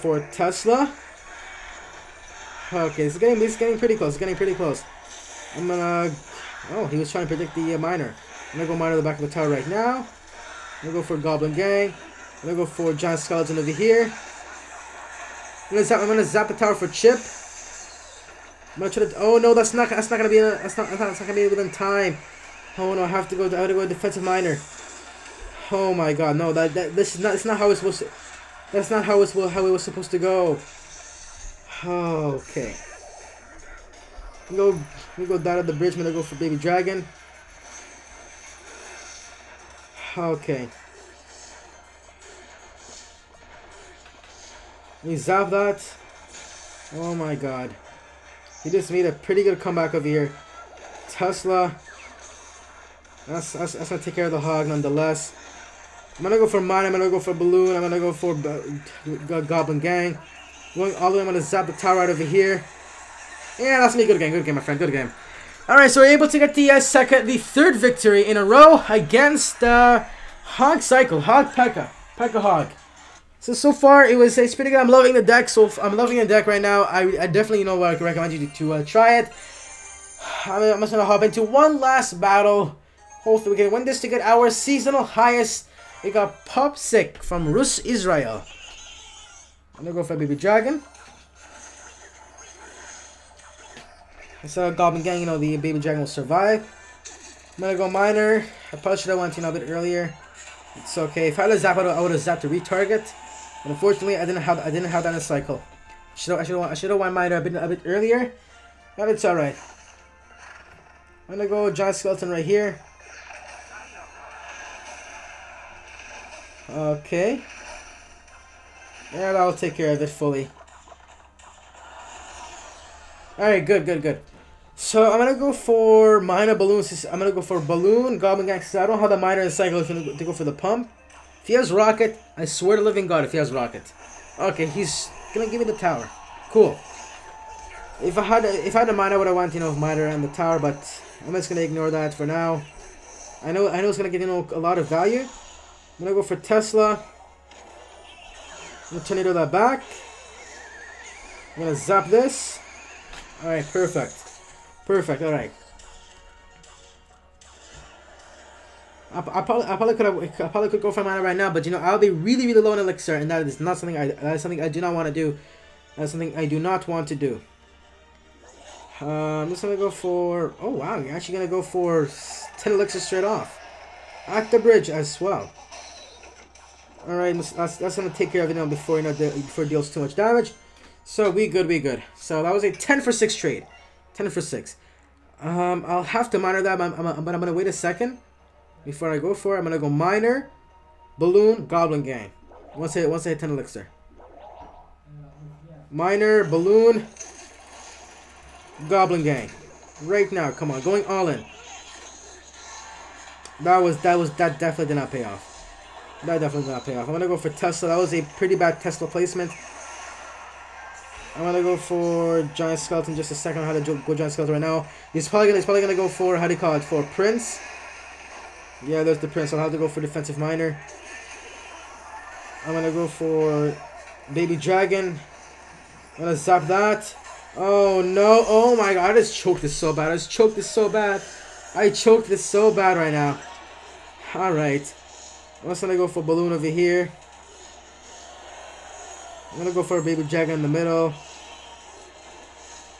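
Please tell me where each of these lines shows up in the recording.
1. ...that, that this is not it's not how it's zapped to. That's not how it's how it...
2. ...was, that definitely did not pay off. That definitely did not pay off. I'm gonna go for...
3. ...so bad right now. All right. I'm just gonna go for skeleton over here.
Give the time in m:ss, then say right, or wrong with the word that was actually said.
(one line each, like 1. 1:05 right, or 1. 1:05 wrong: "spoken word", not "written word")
1. 0:26 wrong: "supposed", not "zapped"
2. 3:24 right
3. 3:52 wrong: "balloon", not "skeleton".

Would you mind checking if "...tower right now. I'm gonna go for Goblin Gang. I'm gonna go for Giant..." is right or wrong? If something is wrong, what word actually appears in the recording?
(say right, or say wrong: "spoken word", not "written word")
right.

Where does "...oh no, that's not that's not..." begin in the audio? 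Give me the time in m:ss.
0:18.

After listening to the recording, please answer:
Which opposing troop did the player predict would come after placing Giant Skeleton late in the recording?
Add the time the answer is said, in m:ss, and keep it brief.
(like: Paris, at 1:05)
Prince, at 3:37.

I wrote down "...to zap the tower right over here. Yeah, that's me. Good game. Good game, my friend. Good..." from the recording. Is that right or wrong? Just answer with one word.
right.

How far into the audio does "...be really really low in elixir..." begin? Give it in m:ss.
2:41.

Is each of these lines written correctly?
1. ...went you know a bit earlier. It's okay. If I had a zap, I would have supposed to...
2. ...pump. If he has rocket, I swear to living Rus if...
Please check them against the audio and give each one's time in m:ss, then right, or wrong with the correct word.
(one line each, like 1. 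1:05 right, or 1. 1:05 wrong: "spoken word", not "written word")
1. 1:39 wrong: "zapped", not "supposed"
2. 2:10 wrong: "God", not "Rus".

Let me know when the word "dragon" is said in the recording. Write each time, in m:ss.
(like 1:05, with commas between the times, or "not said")
0:36, 1:30, 1:35, 3:44, 4:00.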